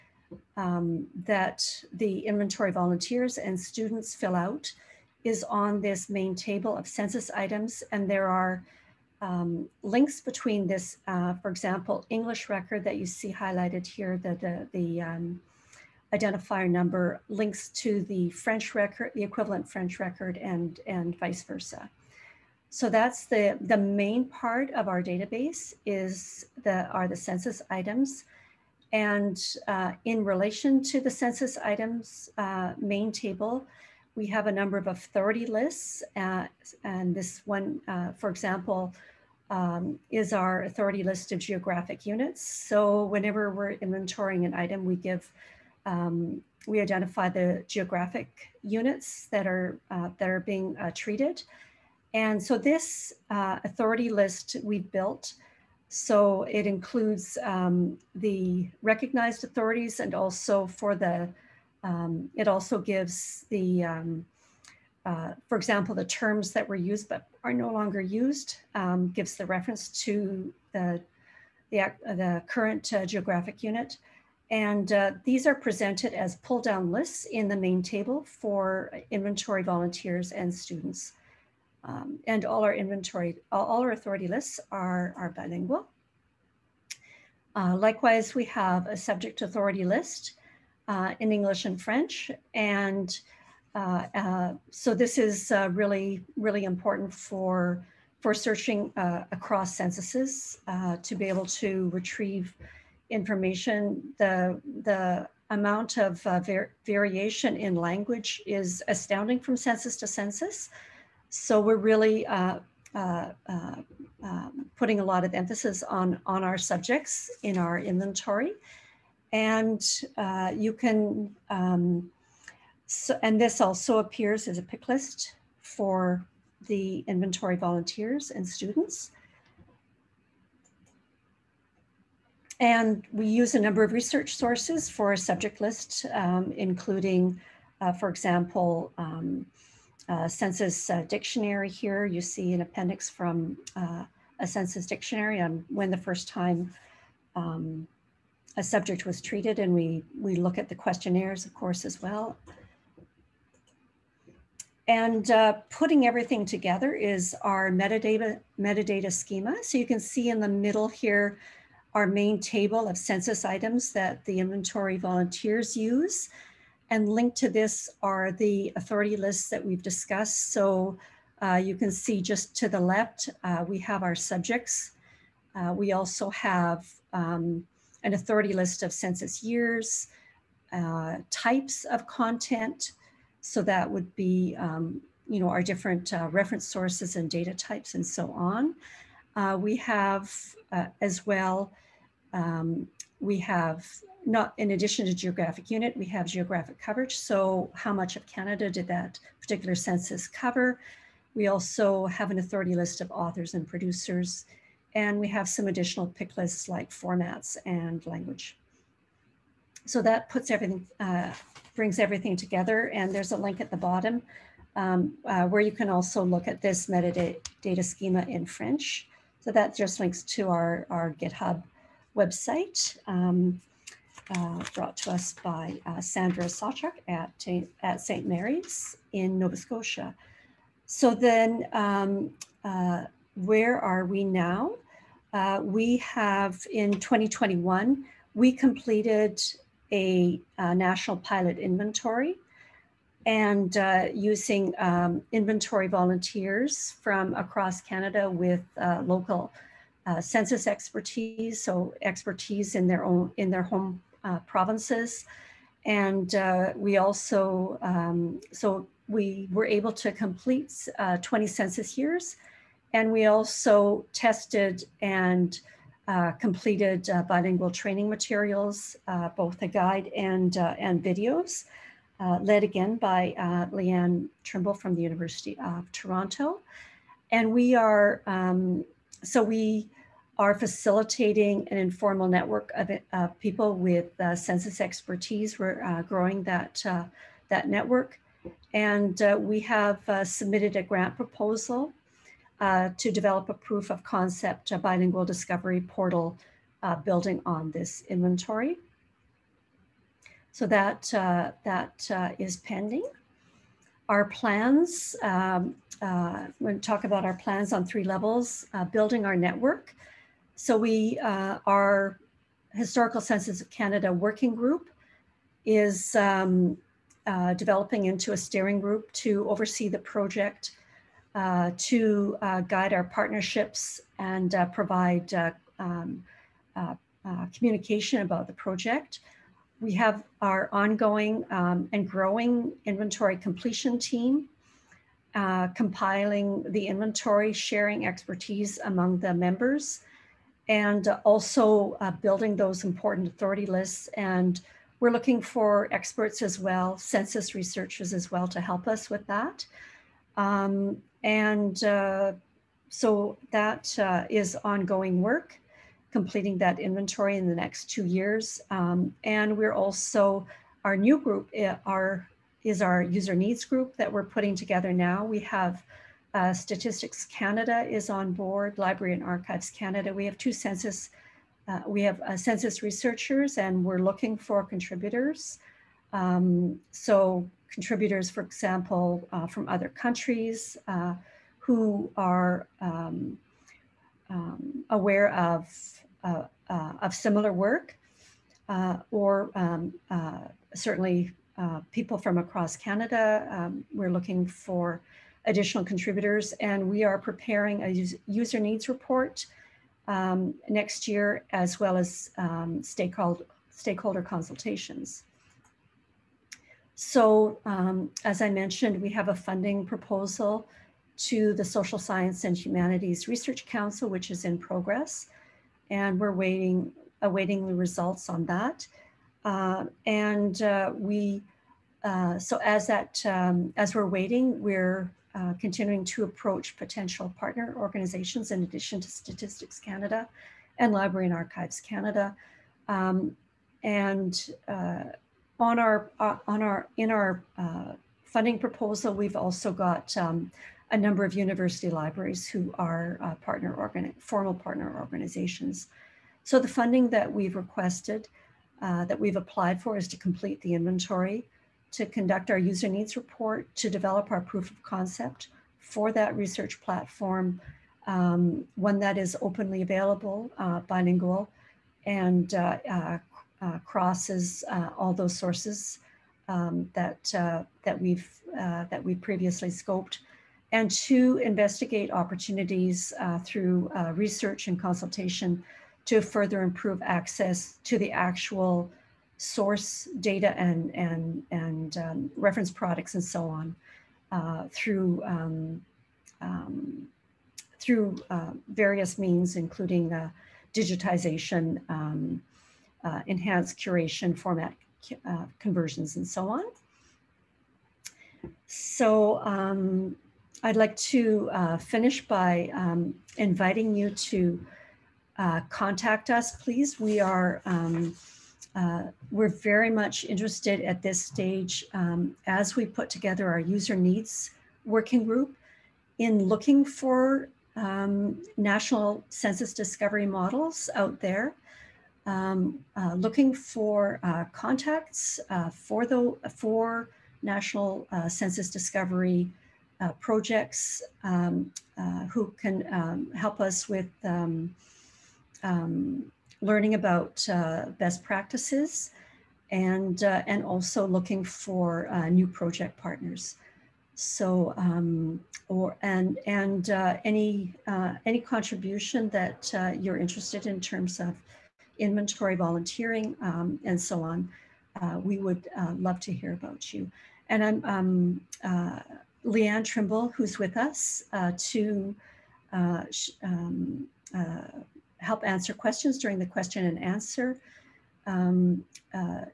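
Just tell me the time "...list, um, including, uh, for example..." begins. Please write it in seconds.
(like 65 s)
135 s.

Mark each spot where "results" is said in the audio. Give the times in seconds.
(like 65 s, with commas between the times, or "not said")
417 s.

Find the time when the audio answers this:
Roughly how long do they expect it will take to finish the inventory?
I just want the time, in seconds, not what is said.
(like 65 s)
357 s.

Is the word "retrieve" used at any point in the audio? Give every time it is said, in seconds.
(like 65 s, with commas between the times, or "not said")
101 s.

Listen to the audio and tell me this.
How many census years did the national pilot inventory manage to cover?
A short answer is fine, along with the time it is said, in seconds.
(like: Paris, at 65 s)
20, at 261 s.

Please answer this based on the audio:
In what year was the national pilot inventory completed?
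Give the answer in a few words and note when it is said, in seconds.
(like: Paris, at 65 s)
2021, at 236 s.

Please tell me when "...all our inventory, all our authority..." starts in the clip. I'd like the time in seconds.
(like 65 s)
82 s.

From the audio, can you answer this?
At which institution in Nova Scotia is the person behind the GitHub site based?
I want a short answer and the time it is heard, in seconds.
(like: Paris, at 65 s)
St. Mary's, at 228 s.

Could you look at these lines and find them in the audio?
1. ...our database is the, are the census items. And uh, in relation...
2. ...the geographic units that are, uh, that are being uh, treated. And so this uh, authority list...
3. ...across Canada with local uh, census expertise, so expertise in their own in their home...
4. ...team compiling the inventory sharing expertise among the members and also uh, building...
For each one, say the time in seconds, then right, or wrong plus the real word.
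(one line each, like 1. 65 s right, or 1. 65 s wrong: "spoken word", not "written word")
1. 24 s right
2. 47 s right
3. 247 s right
4. 333 s right.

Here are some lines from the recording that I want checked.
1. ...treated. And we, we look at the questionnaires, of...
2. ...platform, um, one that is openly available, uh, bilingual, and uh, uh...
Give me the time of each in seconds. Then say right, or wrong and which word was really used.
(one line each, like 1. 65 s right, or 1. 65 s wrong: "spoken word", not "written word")
1. 149 s right
2. 456 s right.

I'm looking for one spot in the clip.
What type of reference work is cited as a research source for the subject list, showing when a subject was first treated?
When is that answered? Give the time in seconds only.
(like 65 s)
144 s.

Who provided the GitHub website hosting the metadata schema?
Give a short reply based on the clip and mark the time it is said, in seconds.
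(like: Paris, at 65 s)
Sandra Sawchuk, at 226 s.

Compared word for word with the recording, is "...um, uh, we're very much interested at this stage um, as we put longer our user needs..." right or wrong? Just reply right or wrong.
wrong.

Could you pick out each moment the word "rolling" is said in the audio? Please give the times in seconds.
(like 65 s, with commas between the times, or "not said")
not said.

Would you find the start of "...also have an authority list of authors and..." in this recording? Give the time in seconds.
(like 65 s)
201 s.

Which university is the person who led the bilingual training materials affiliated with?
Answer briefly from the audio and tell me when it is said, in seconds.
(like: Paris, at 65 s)
University of Toronto, at 275 s.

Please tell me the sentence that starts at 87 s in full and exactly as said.
Uh, likewise, we have a subject authority list uh, in English and French.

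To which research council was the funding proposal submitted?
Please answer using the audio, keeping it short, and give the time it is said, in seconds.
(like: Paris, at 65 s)
Social Science and Humanities Research Council, at 411 s.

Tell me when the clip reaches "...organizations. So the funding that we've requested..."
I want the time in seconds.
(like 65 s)
444 s.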